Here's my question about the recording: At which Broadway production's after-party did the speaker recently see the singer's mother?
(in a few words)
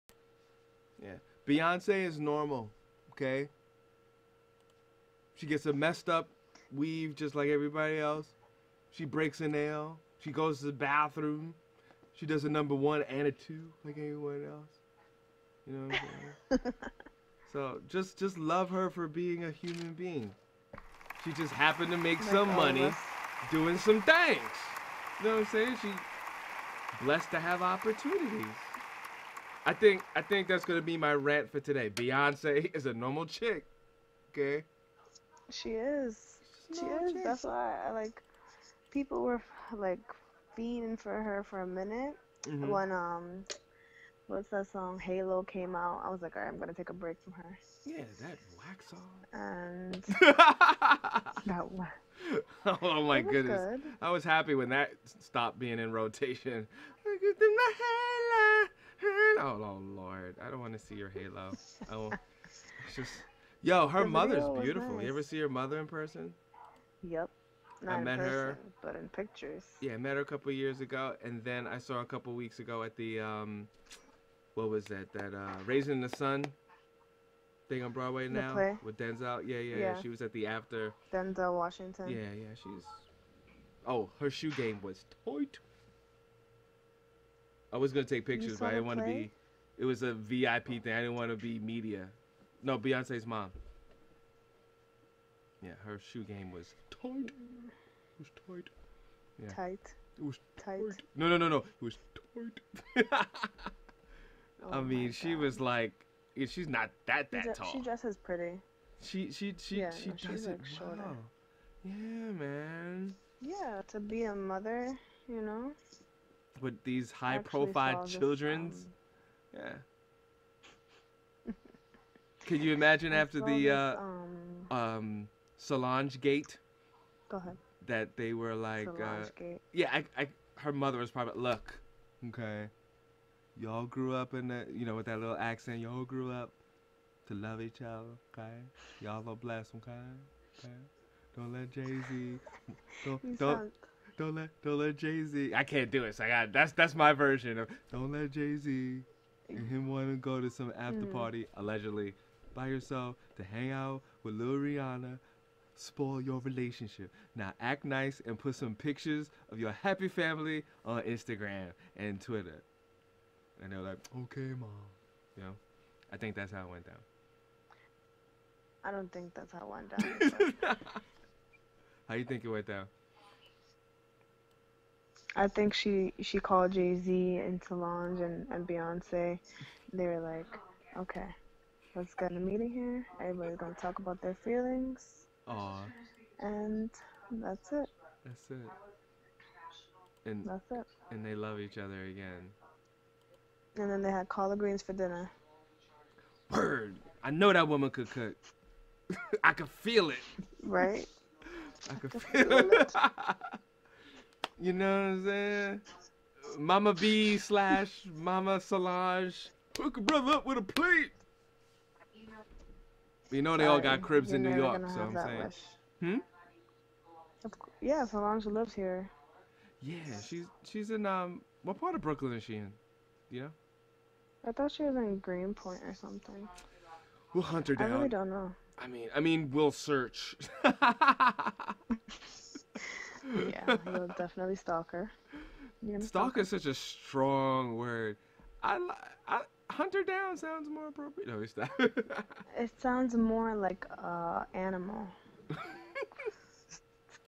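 Raisin in the Sun.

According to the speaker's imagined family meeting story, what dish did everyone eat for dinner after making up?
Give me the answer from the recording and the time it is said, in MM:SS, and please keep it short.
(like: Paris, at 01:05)
Collard greens, at 03:14.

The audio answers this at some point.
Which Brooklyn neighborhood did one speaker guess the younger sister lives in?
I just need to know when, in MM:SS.
03:45.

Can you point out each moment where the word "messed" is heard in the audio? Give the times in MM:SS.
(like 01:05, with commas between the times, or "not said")
00:05.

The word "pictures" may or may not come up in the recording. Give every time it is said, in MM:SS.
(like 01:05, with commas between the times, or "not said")
01:09, 01:28, 02:38.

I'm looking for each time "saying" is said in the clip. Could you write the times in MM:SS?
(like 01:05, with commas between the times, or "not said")
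00:16, 00:25, 03:25, 03:35.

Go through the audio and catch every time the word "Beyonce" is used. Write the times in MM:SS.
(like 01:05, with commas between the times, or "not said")
00:01, 00:31, 01:32, 02:58.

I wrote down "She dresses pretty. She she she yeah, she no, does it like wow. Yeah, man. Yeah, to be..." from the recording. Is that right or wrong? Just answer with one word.
right.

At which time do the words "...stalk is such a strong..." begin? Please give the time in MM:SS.
03:56.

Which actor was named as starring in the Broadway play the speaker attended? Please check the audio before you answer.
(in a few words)
Denzel Washington.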